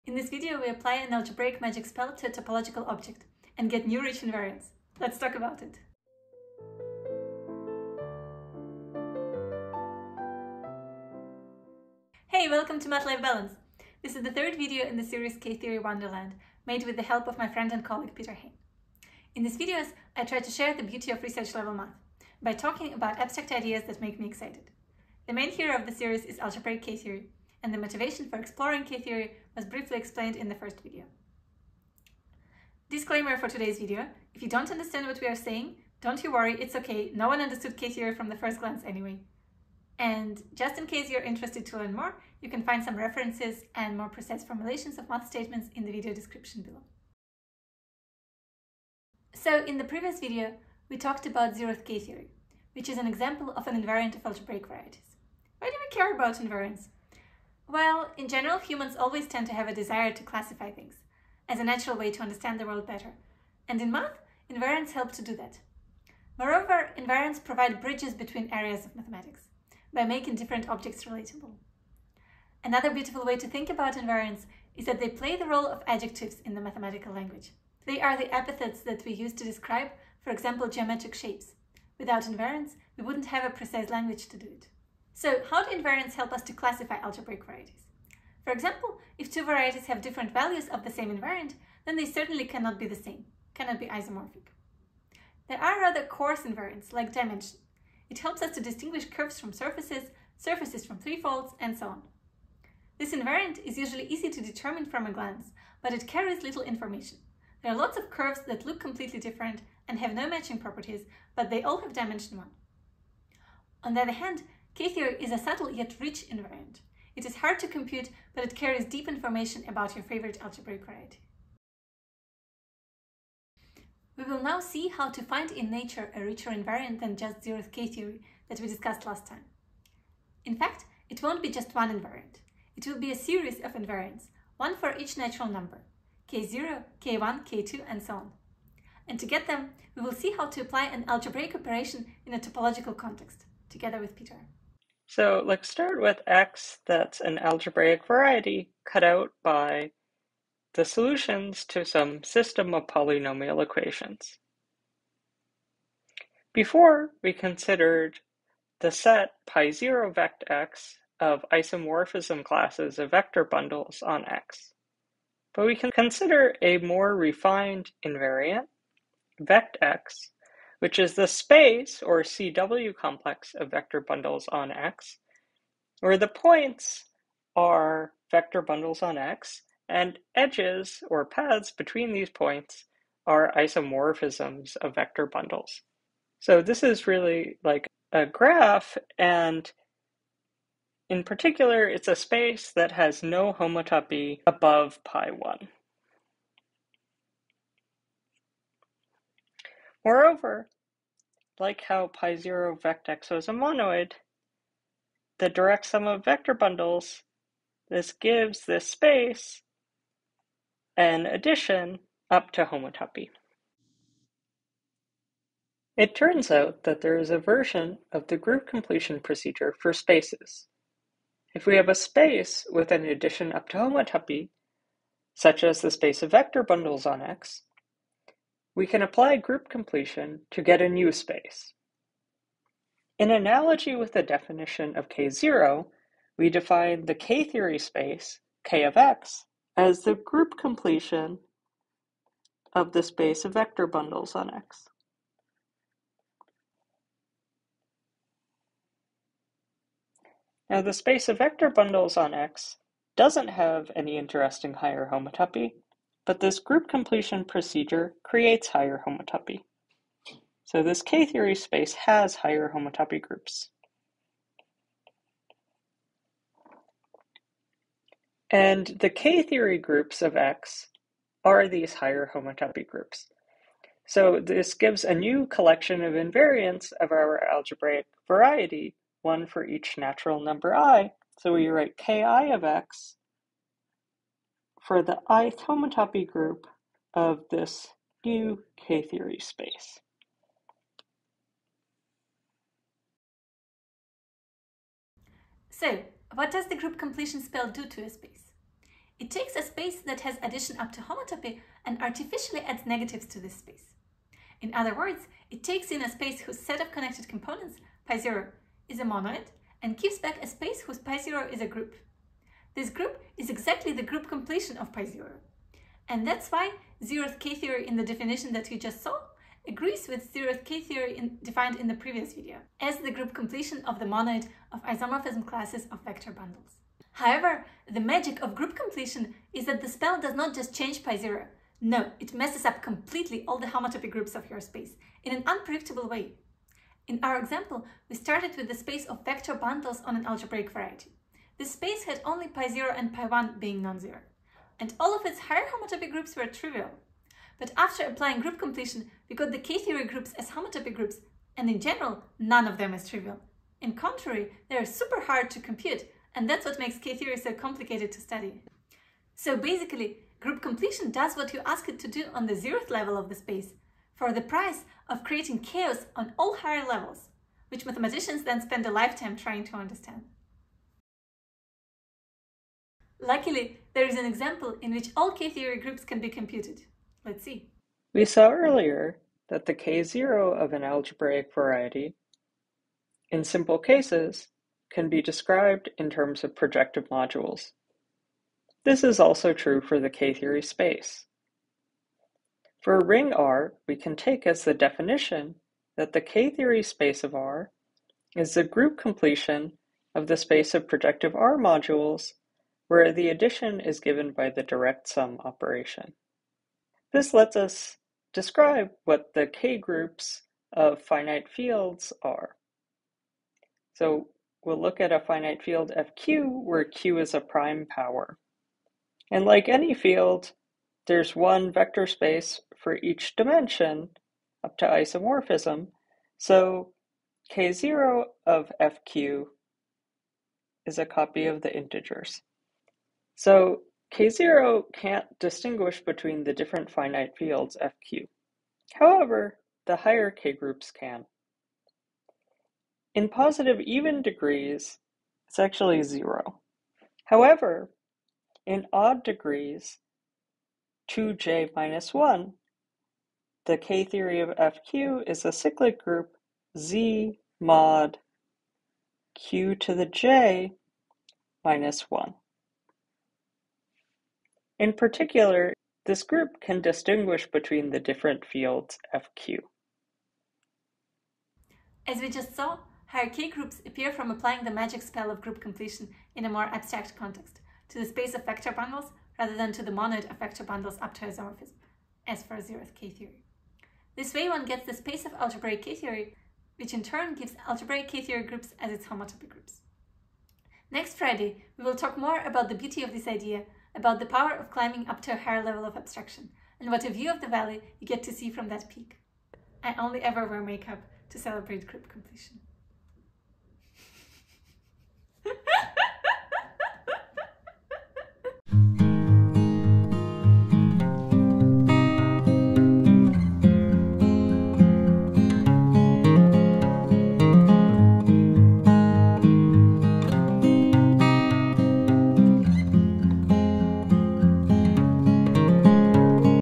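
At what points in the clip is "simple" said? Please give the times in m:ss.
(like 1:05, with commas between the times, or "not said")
6:23.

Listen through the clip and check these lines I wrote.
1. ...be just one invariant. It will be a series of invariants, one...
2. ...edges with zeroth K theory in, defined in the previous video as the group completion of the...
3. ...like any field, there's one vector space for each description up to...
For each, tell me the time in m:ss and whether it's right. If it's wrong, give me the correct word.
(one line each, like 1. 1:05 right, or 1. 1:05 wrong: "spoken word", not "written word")
1. 2:11 right
2. 5:19 wrong: "agrees", not "edges"
3. 6:59 wrong: "dimension", not "description".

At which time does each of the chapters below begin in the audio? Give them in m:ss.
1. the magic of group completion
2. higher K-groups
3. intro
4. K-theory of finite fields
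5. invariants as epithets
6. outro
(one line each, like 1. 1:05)
1. 4:53
2. 2:01
3. 0:11
4. 6:11
5. 0:47
6. 7:51.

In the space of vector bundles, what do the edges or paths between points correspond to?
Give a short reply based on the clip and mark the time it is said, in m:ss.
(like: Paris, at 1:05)
isomorphisms of vector bundles, at 3:03.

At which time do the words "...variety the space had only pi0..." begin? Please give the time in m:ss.
5:40.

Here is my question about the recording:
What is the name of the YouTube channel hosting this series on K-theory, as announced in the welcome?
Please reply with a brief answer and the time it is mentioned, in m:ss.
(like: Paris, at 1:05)
Math-life Balance, at 0:12.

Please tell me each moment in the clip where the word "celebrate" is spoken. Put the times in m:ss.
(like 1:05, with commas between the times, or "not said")
8:21.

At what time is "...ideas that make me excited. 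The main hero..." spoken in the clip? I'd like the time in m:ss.
0:23.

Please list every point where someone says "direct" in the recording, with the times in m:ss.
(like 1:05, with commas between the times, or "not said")
3:25, 6:44.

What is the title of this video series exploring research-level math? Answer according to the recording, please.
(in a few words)
K-Theory Wonderland.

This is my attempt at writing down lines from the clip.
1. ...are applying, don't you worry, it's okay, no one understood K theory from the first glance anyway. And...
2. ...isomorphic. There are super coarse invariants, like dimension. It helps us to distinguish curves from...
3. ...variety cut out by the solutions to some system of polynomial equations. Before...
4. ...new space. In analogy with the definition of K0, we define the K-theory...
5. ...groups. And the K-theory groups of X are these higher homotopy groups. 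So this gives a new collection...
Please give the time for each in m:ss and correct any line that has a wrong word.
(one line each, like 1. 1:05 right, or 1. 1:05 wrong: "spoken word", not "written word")
1. 0:35 wrong: "saying", not "applying"
2. 1:33 wrong: "rather", not "super"
3. 2:28 right
4. 3:50 right
5. 4:23 right.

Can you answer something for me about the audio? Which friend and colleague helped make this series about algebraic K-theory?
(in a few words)
Peter Haine.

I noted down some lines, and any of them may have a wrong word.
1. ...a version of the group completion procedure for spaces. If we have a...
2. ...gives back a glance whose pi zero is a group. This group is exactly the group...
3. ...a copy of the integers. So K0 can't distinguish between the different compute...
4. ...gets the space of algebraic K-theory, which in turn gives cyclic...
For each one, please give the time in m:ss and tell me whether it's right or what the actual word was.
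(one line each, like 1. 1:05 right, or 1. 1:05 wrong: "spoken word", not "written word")
1. 3:37 right
2. 5:09 wrong: "space", not "glance"
3. 7:10 wrong: "finite", not "compute"
4. 8:04 wrong: "algebraic", not "cyclic".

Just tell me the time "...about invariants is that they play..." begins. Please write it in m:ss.
1:13.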